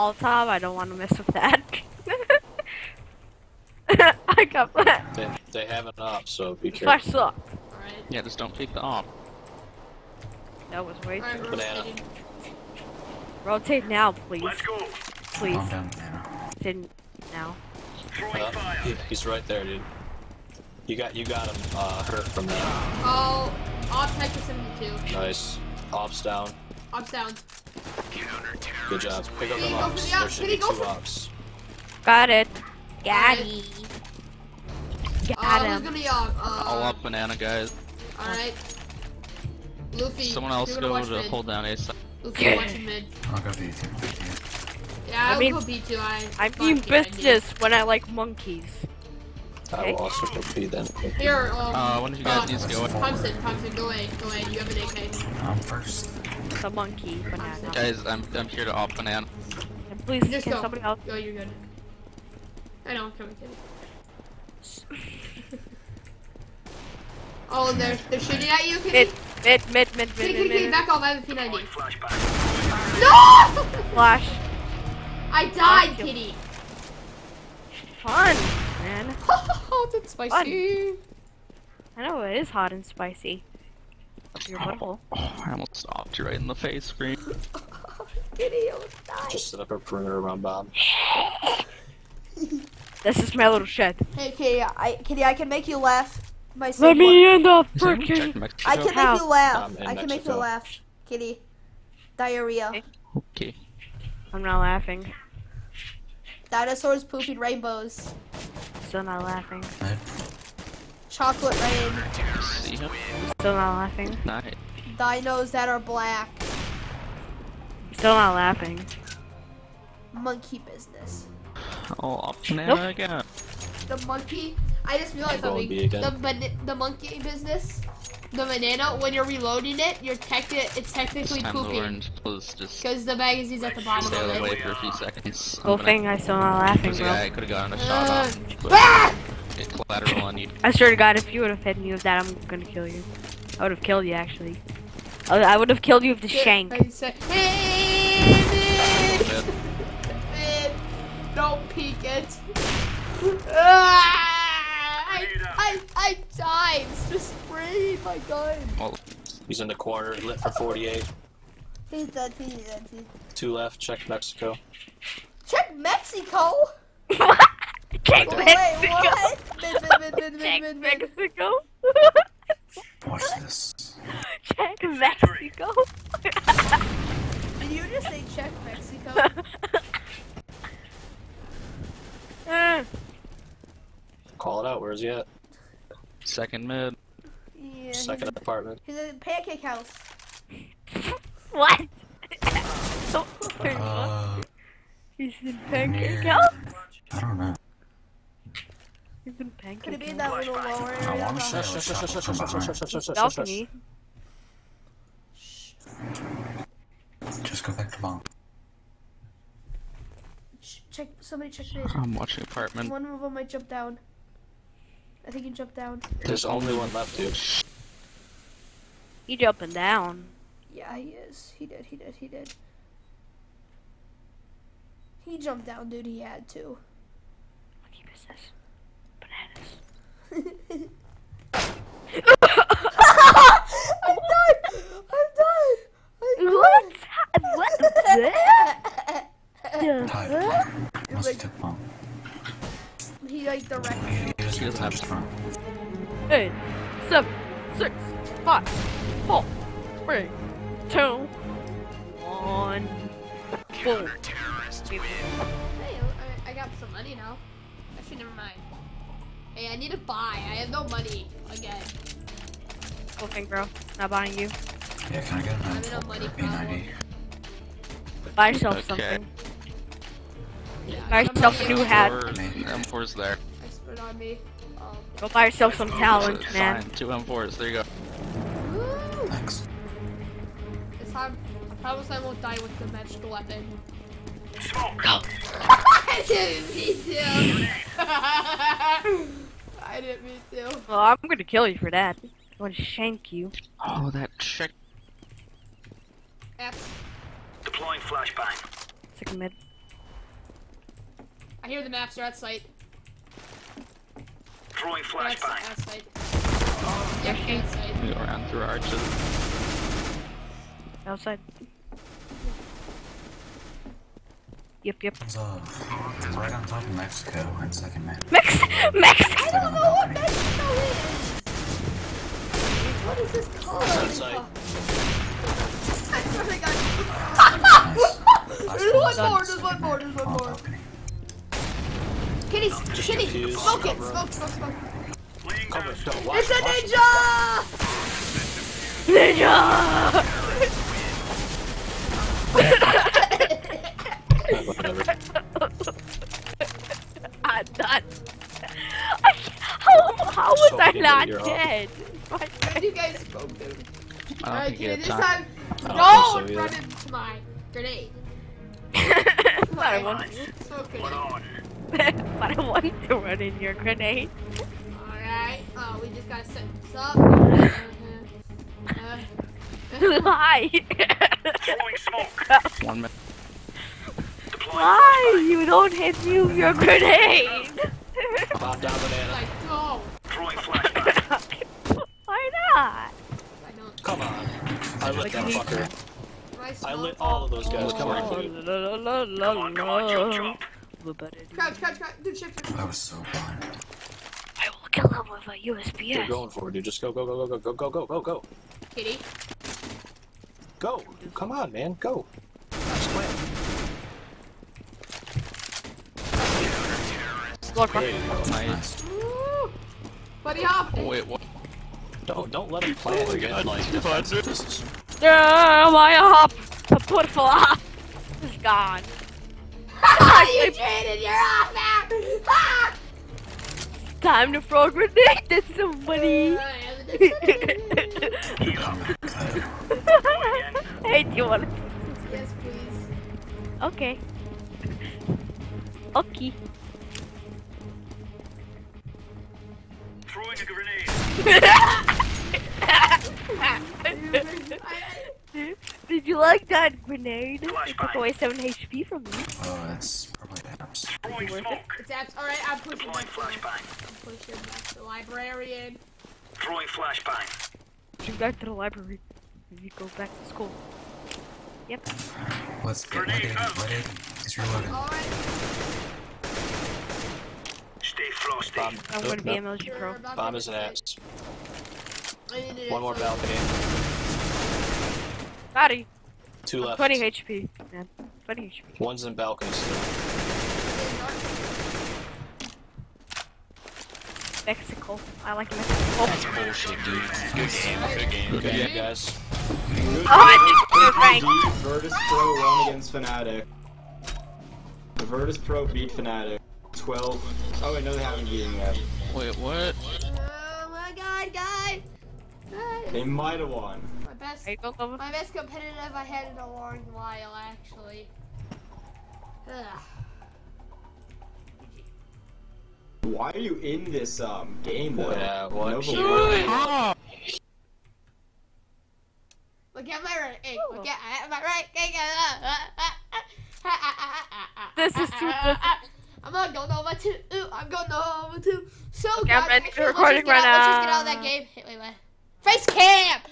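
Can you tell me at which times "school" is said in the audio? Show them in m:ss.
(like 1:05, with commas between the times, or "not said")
7:40.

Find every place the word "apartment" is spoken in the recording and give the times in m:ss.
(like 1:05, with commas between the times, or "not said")
3:08, 3:32.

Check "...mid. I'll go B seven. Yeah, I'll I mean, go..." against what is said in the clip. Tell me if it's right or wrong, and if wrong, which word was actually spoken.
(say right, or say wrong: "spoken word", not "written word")
wrong: "two", not "seven".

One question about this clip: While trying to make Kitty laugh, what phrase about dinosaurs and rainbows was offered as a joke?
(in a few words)
Dinosaurs pooping rainbows.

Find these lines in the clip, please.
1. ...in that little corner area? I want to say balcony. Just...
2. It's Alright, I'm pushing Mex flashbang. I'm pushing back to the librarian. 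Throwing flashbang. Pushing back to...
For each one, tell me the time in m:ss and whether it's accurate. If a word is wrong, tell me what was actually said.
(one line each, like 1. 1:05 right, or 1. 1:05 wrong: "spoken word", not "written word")
1. 3:20 wrong: "lower", not "corner"
2. 7:31 wrong: "Deploying", not "Mex".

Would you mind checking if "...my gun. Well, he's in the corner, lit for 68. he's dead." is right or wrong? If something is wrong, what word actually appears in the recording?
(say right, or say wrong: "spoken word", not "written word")
wrong: "48", not "68".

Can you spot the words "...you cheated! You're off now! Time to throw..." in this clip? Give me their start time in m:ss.
7:00.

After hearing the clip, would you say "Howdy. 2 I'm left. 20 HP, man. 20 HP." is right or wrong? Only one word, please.
right.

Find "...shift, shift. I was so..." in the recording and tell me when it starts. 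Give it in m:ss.
6:32.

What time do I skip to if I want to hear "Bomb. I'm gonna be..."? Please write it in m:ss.
7:48.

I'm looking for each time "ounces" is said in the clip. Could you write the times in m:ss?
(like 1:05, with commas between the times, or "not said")
not said.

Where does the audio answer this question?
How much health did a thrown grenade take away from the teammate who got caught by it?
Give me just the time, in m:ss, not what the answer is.
7:28.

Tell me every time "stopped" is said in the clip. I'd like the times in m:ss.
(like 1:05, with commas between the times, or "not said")
1:25.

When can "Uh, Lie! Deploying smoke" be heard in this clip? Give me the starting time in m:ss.
6:08.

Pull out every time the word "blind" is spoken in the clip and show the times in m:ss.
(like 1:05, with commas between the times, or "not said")
6:33.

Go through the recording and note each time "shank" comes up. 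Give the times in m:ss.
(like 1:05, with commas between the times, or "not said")
2:26, 4:52.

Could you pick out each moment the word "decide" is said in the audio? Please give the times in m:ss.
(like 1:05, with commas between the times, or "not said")
not said.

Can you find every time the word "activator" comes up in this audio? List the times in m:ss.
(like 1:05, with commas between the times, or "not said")
not said.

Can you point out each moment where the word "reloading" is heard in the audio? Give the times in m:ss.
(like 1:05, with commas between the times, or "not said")
2:09, 7:44.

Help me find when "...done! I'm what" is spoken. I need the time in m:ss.
3:55.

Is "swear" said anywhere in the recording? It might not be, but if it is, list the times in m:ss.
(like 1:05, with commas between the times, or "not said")
2:20, 5:26.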